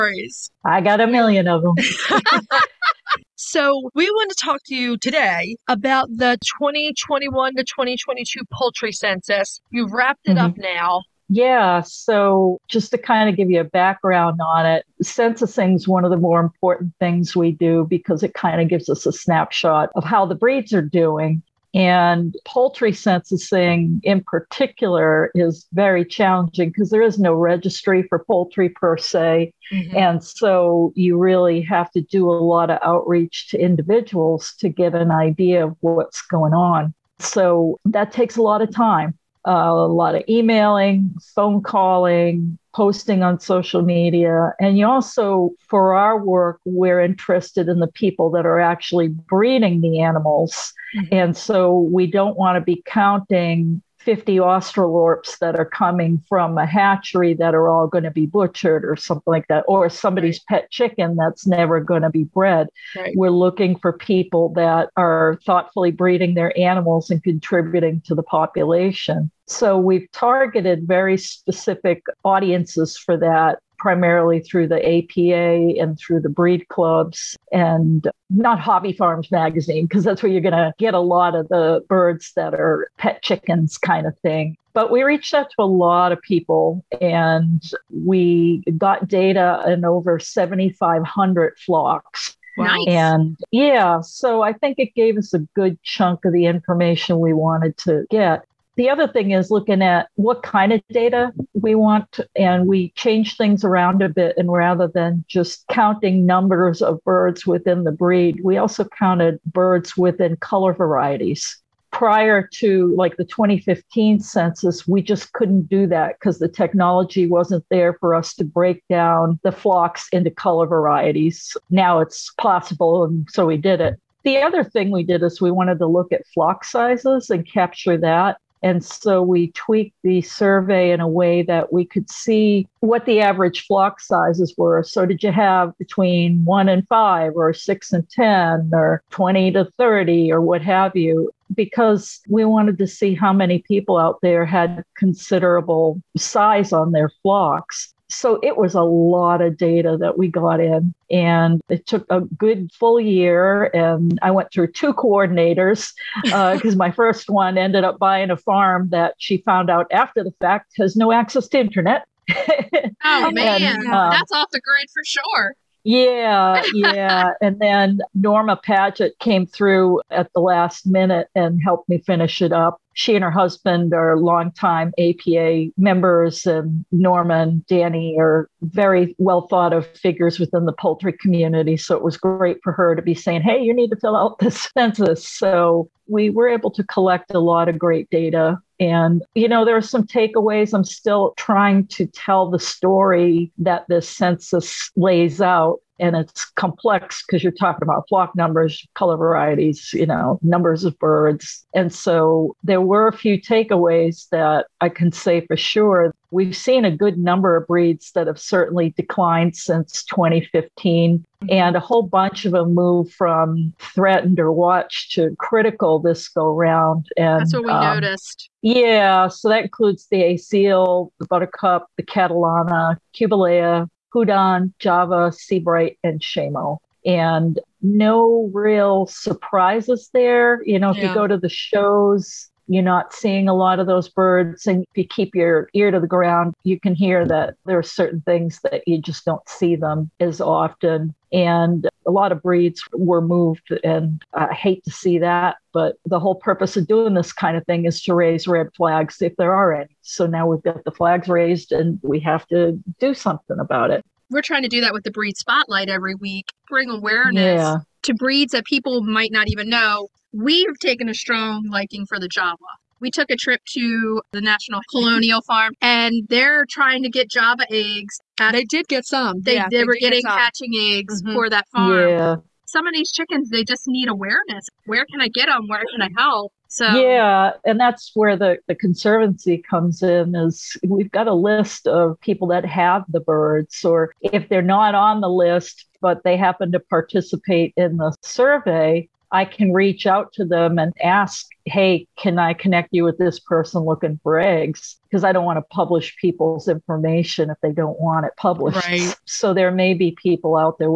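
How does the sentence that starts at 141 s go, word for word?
Because we wanted to see how many people out there had considerable size on their flocks.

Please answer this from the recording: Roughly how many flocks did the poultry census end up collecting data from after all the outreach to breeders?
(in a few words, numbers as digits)
over 7,500.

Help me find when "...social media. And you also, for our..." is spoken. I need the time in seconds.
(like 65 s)
43 s.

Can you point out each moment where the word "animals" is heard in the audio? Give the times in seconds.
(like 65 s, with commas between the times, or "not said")
49 s, 66 s.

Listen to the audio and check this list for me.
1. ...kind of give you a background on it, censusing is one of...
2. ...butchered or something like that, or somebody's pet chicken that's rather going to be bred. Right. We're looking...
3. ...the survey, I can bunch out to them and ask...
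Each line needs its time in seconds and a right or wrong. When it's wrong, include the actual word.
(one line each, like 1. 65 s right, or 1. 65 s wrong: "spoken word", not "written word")
1. 12 s right
2. 58 s wrong: "never", not "rather"
3. 287 s wrong: "reach", not "bunch".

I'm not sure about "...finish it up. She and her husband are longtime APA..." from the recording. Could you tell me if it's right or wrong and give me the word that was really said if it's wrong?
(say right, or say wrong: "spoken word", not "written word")
right.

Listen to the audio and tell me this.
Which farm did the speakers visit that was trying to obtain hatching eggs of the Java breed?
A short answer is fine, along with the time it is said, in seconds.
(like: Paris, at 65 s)
National Colonial Farm, at 264 s.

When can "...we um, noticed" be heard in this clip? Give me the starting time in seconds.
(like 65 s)
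217 s.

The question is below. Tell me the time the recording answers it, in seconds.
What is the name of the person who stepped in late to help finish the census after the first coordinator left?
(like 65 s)
168 s.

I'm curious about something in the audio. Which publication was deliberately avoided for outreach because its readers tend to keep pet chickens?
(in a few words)
Hobby Farms.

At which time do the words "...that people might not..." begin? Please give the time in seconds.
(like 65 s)
258 s.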